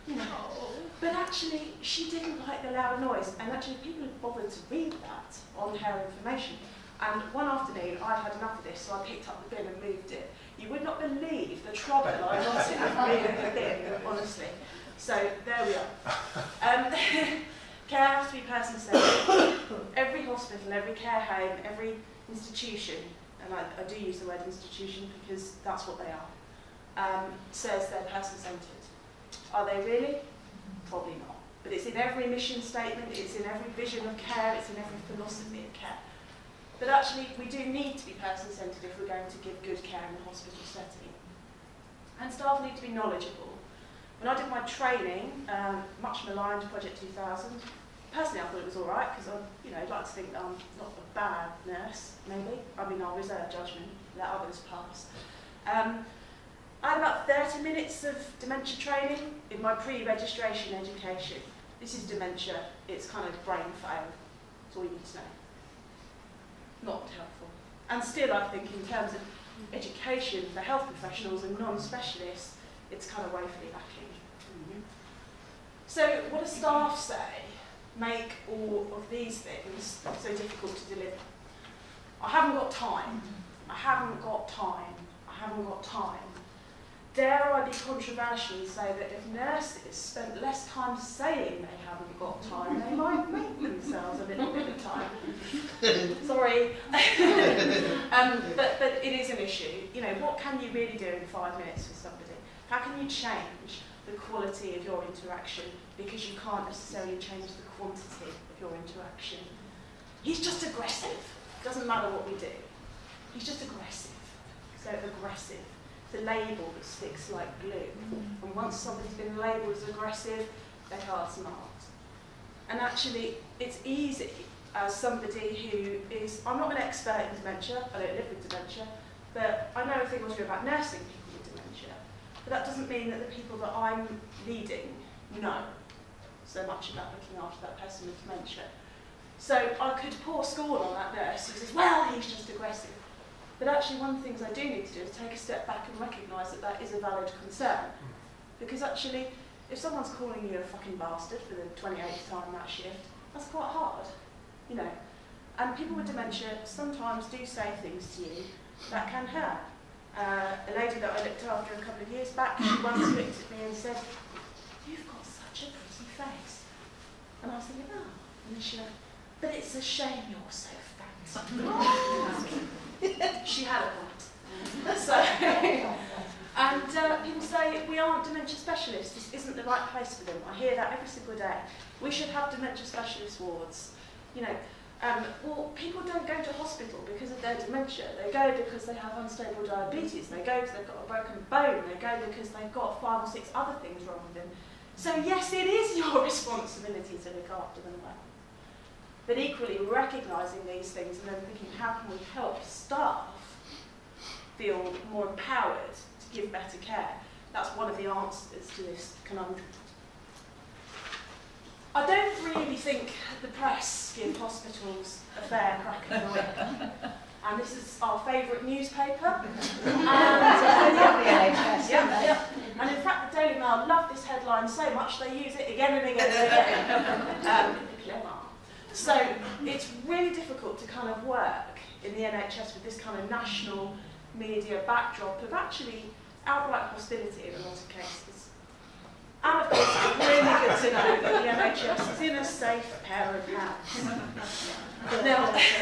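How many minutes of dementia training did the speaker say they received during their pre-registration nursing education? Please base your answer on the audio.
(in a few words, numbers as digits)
30.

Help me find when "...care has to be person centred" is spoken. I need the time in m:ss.
0:17.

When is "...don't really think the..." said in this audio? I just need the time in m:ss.
3:32.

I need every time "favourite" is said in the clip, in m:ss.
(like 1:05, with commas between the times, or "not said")
3:38.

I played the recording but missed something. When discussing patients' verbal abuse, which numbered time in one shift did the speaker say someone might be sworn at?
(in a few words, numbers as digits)
28th.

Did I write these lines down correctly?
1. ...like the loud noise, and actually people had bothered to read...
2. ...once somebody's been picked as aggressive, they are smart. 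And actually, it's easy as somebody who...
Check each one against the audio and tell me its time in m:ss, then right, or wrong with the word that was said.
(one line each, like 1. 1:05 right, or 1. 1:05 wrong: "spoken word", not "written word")
1. 0:02 right
2. 1:58 wrong: "labelled", not "picked".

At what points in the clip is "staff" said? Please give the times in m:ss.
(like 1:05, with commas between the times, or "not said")
0:42, 1:16, 3:22.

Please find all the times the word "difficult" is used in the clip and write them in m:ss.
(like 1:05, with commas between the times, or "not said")
1:20, 3:50.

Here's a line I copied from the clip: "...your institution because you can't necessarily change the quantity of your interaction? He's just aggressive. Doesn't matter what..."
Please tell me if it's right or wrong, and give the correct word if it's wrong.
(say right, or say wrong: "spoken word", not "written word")
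wrong: "interaction", not "institution".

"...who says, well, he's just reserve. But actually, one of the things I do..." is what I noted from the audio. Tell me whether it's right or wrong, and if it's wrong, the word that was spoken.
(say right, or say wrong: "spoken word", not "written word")
wrong: "aggressive", not "reserve".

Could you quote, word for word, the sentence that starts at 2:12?
But that doesn't mean that the people that I'm leading know so much about looking after that person with dementia.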